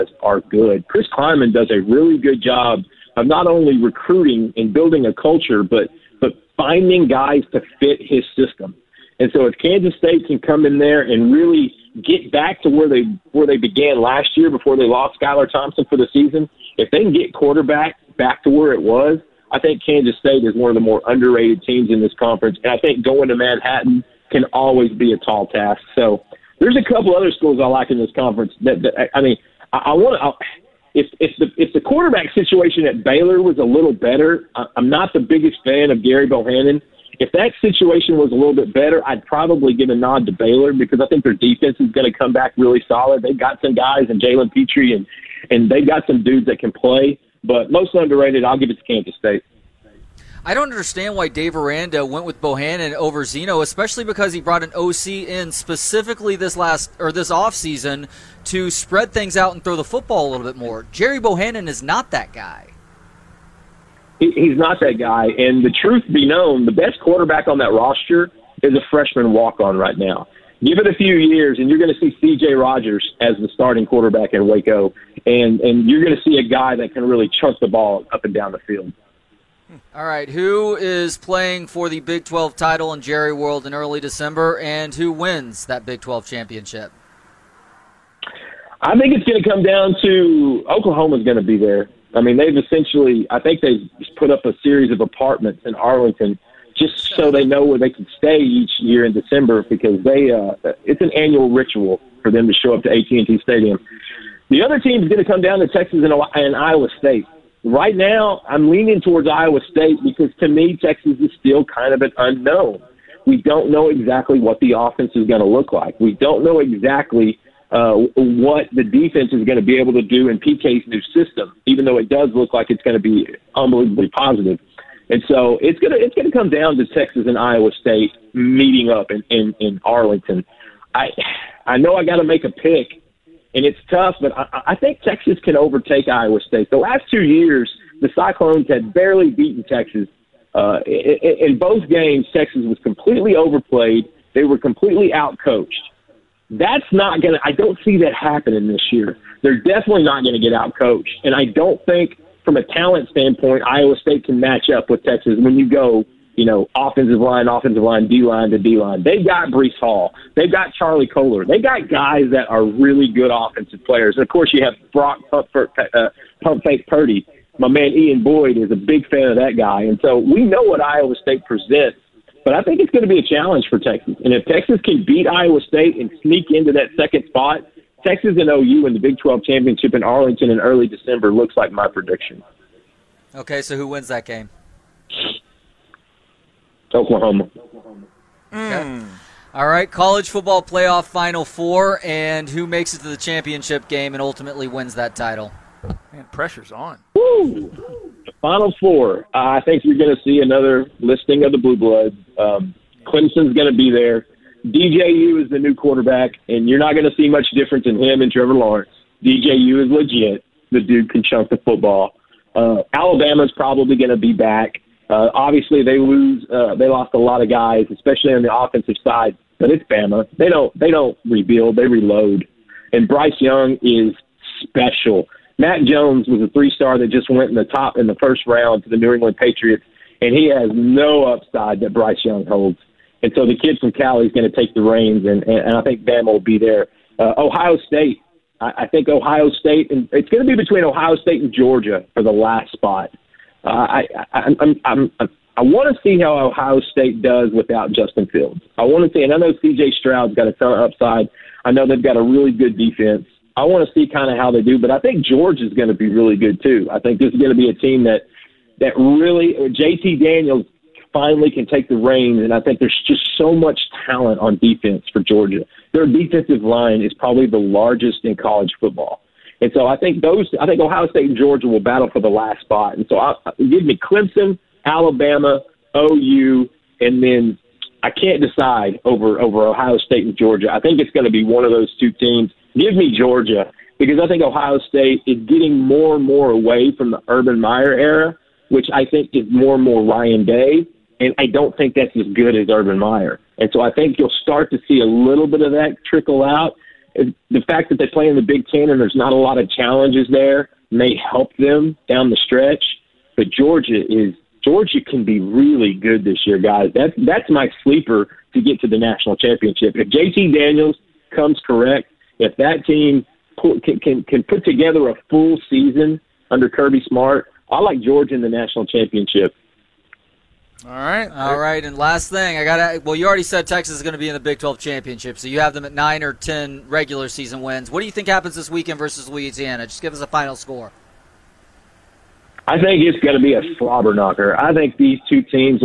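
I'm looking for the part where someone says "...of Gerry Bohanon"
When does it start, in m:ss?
0:35.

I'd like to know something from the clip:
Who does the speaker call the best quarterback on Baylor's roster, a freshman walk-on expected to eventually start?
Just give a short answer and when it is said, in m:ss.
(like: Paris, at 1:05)
CJ Rogers, at 1:12.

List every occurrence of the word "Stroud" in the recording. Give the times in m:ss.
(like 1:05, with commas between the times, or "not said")
4:09.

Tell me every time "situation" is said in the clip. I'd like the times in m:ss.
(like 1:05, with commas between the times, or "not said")
0:32, 0:37.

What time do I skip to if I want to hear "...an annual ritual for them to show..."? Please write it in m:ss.
1:41.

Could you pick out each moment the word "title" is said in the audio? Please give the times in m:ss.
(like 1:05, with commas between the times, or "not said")
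1:22, 3:15.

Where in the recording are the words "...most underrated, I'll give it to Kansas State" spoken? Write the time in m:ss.
0:47.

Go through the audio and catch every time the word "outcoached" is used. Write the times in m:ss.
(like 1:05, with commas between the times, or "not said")
2:25, 2:30.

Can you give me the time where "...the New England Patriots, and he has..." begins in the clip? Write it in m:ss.
3:48.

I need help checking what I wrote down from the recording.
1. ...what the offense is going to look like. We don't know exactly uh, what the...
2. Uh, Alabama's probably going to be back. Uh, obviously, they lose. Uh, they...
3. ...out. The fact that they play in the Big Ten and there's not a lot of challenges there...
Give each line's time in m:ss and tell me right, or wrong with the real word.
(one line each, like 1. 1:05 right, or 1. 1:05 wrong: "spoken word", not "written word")
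1. 1:54 right
2. 3:32 right
3. 4:56 right.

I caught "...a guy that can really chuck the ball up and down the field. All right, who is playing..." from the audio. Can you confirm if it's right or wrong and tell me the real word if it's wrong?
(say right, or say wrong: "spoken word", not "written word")
right.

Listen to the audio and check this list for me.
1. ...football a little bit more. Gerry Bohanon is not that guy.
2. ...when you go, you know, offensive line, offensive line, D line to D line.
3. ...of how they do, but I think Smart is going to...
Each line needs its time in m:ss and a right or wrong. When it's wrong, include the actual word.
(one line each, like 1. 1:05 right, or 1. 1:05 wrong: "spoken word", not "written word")
1. 0:59 right
2. 2:35 right
3. 4:14 wrong: "George", not "Smart".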